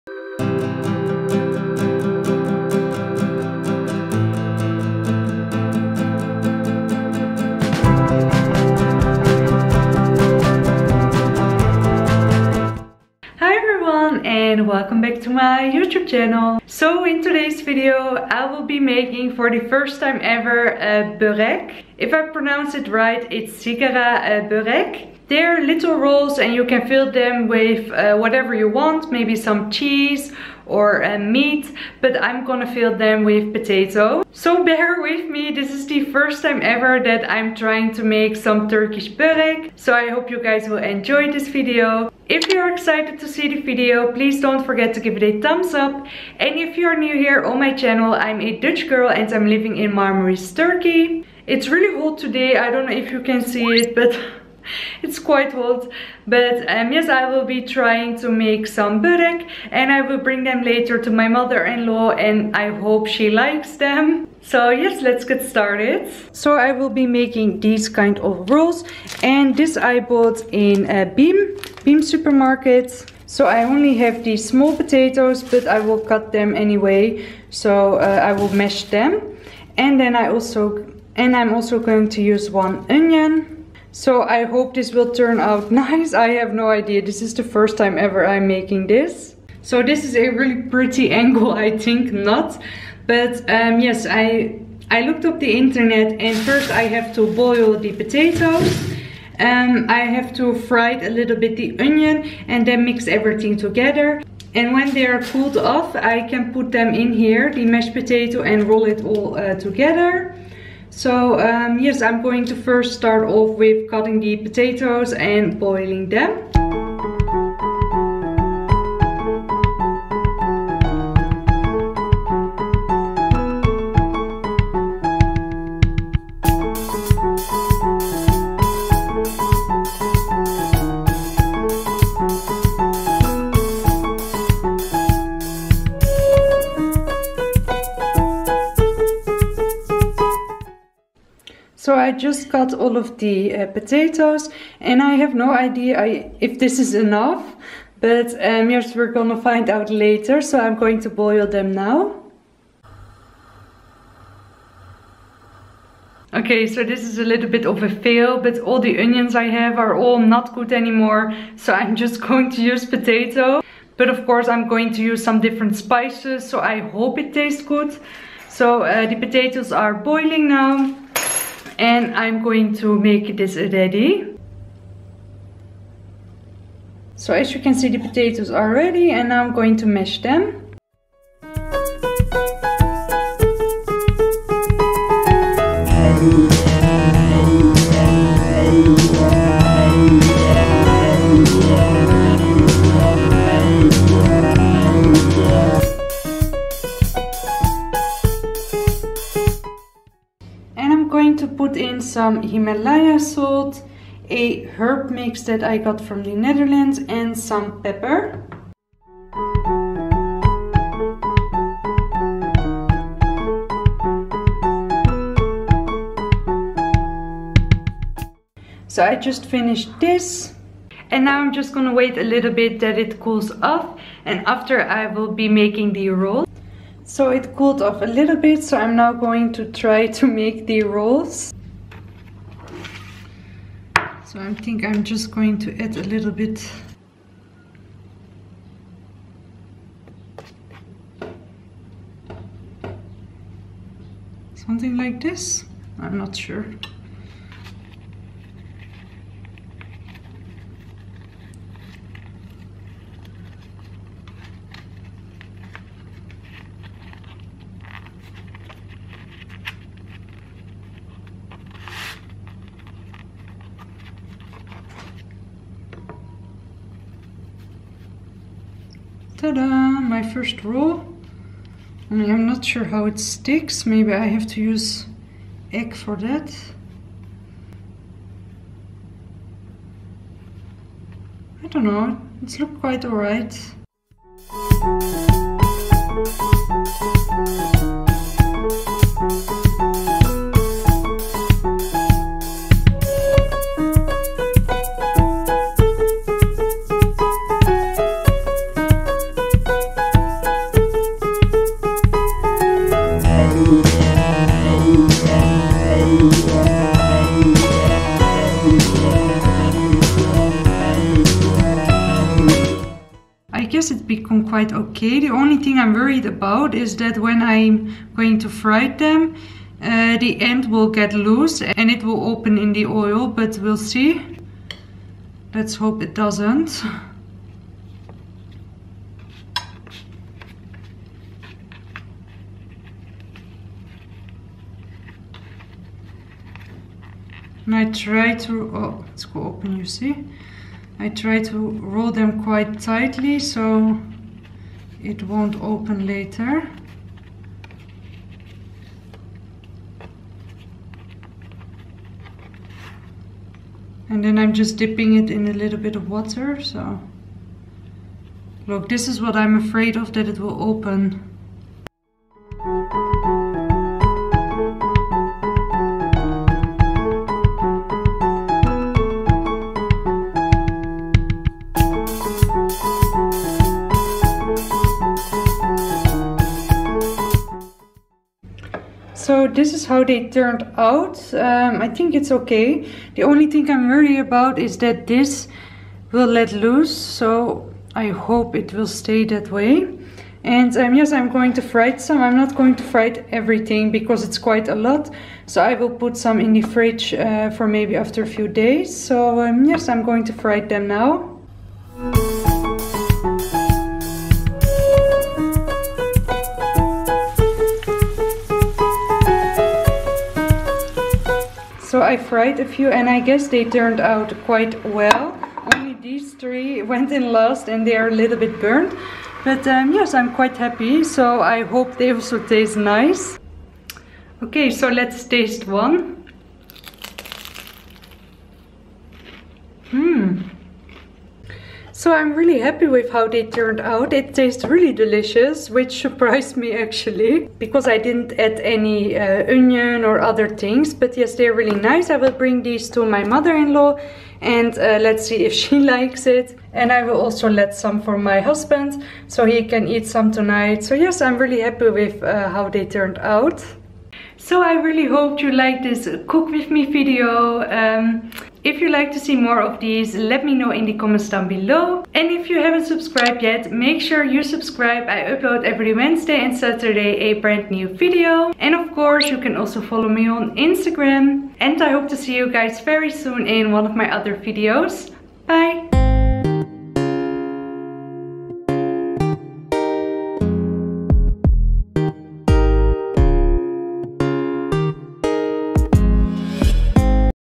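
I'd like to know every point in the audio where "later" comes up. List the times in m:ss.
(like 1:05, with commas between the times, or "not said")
1:00, 2:29, 5:46.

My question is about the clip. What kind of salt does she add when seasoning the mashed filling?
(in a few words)
Himalaya salt.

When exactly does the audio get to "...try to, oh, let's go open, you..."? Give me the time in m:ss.
5:37.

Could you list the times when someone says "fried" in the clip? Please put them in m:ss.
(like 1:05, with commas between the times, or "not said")
6:52.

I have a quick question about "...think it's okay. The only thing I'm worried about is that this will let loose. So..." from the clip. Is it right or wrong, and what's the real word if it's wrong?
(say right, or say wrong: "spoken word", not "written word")
right.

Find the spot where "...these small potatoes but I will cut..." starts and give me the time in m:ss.
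1:14.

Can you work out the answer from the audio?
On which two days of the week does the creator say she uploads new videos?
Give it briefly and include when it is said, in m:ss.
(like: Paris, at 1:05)
Wednesday and Saturday, at 7:45.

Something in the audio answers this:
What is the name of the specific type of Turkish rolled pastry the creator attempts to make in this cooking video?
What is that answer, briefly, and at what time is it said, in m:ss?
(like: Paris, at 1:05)
sigara börek, at 0:23.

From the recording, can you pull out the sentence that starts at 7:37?
Um, if you'd like to see more of these, let me know in the comments down below.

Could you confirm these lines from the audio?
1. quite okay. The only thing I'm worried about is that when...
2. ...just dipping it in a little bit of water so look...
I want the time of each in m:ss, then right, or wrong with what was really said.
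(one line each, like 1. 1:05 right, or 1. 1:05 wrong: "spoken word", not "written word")
1. 5:14 right
2. 5:54 right.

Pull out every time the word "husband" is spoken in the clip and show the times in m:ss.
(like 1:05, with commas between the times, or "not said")
7:28.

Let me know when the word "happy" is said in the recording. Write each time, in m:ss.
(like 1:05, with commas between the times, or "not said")
7:00, 7:12, 7:31.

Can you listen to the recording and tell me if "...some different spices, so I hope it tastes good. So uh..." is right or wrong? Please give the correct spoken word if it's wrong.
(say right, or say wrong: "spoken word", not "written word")
right.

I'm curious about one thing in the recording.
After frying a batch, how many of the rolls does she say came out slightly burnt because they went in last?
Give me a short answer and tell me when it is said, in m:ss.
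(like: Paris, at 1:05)
3, at 6:56.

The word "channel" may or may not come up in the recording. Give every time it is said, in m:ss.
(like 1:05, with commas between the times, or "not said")
0:16, 0:47.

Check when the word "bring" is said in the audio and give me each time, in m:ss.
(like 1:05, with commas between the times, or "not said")
1:00, 7:22.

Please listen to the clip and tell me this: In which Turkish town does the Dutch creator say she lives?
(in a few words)
Marmaris.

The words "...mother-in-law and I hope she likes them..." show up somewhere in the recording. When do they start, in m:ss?
1:01.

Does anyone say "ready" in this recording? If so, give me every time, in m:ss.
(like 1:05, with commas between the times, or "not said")
2:53, 2:58.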